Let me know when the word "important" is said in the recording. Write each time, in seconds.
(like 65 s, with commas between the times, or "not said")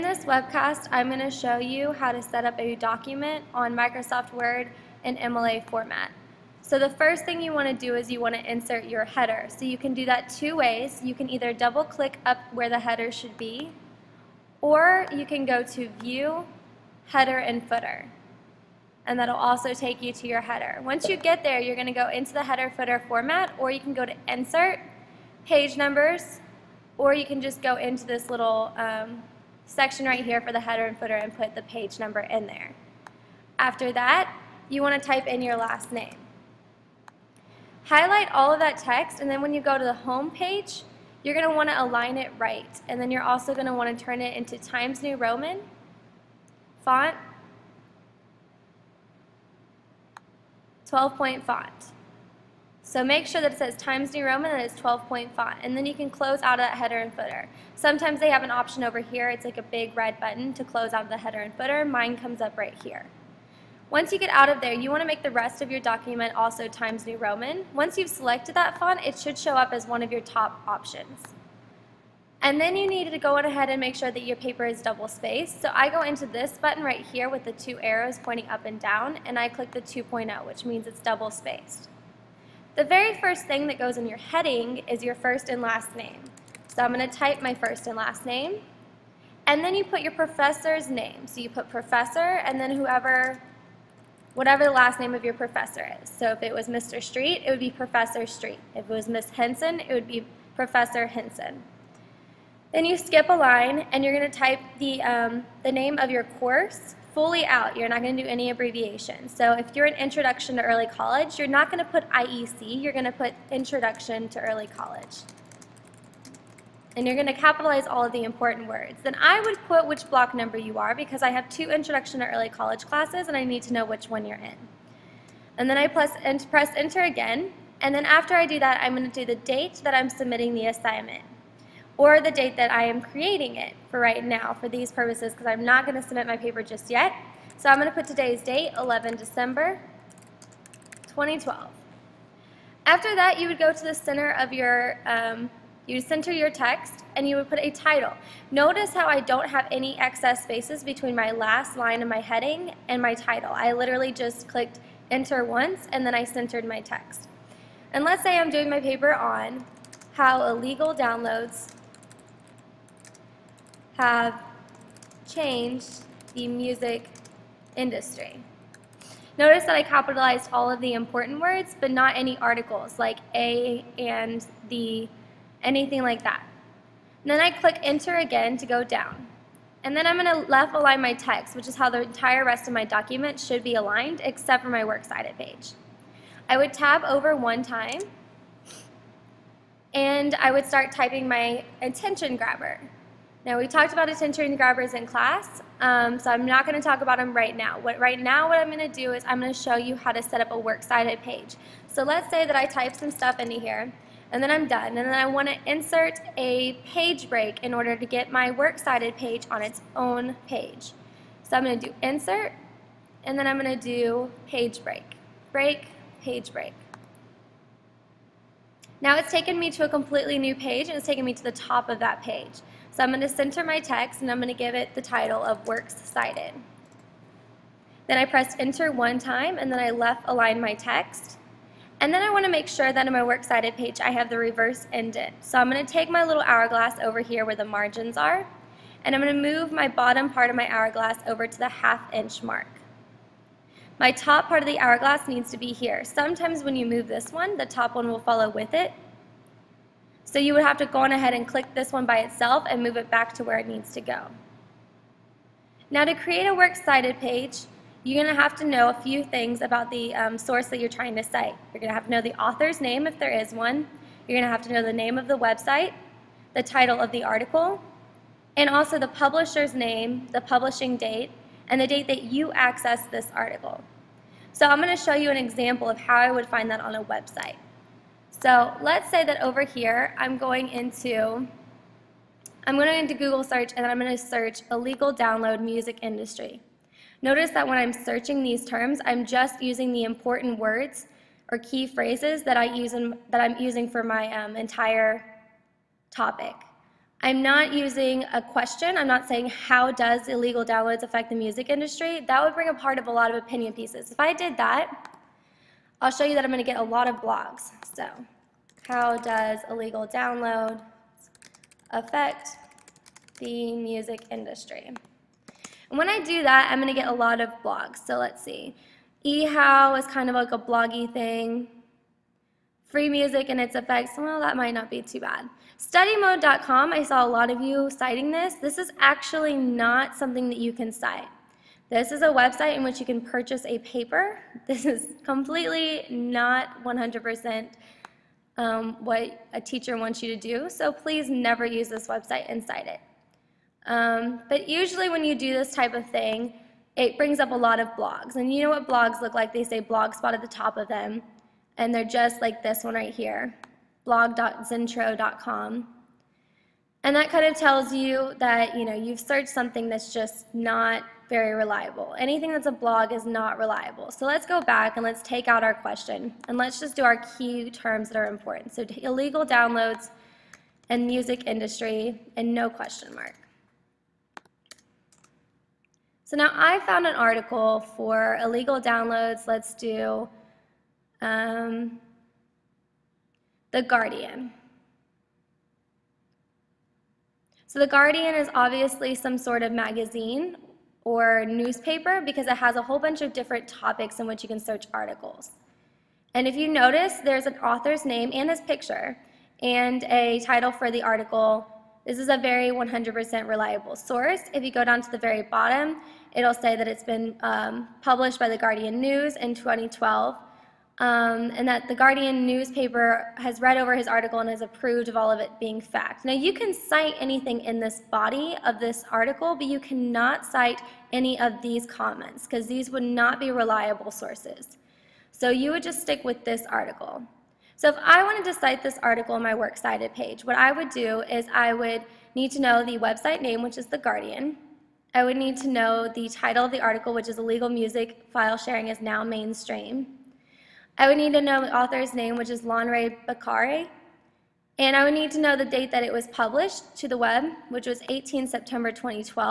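118 s, 170 s, 290 s, 368 s.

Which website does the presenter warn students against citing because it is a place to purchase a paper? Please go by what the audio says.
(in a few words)
Studymode.com.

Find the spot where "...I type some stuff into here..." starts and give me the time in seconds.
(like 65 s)
202 s.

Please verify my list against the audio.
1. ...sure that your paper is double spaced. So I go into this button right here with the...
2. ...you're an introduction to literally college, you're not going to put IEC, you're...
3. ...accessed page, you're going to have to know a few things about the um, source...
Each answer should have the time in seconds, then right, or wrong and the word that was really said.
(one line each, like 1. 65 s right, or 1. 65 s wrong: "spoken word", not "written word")
1. 73 s right
2. 109 s wrong: "early", not "literally"
3. 256 s wrong: "cited", not "accessed".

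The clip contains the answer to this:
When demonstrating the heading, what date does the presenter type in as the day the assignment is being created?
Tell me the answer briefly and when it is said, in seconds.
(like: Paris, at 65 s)
11 December 2012, at 138 s.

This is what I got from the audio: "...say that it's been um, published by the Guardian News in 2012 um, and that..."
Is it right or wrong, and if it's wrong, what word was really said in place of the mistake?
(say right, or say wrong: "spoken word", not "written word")
right.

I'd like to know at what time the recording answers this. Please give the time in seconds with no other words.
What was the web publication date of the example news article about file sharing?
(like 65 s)
448 s.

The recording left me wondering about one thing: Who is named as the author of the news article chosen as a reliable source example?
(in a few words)
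Lanre Bakare.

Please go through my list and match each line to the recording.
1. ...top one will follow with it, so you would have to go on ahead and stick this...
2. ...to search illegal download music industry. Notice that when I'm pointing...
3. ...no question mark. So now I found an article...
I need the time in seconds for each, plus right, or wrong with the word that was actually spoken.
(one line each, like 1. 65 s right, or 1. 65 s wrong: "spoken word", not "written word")
1. 247 s wrong: "click", not "stick"
2. 284 s wrong: "searching", not "pointing"
3. 372 s right.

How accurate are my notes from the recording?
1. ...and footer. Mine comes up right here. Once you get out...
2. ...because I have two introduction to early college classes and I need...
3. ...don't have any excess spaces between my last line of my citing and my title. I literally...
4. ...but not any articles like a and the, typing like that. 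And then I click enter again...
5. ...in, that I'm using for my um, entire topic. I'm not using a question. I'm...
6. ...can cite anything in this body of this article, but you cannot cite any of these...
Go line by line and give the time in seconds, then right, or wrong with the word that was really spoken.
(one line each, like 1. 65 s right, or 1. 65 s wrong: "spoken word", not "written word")
1. 61 s right
2. 120 s right
3. 149 s wrong: "heading", not "citing"
4. 171 s wrong: "anything", not "typing"
5. 292 s right
6. 416 s right.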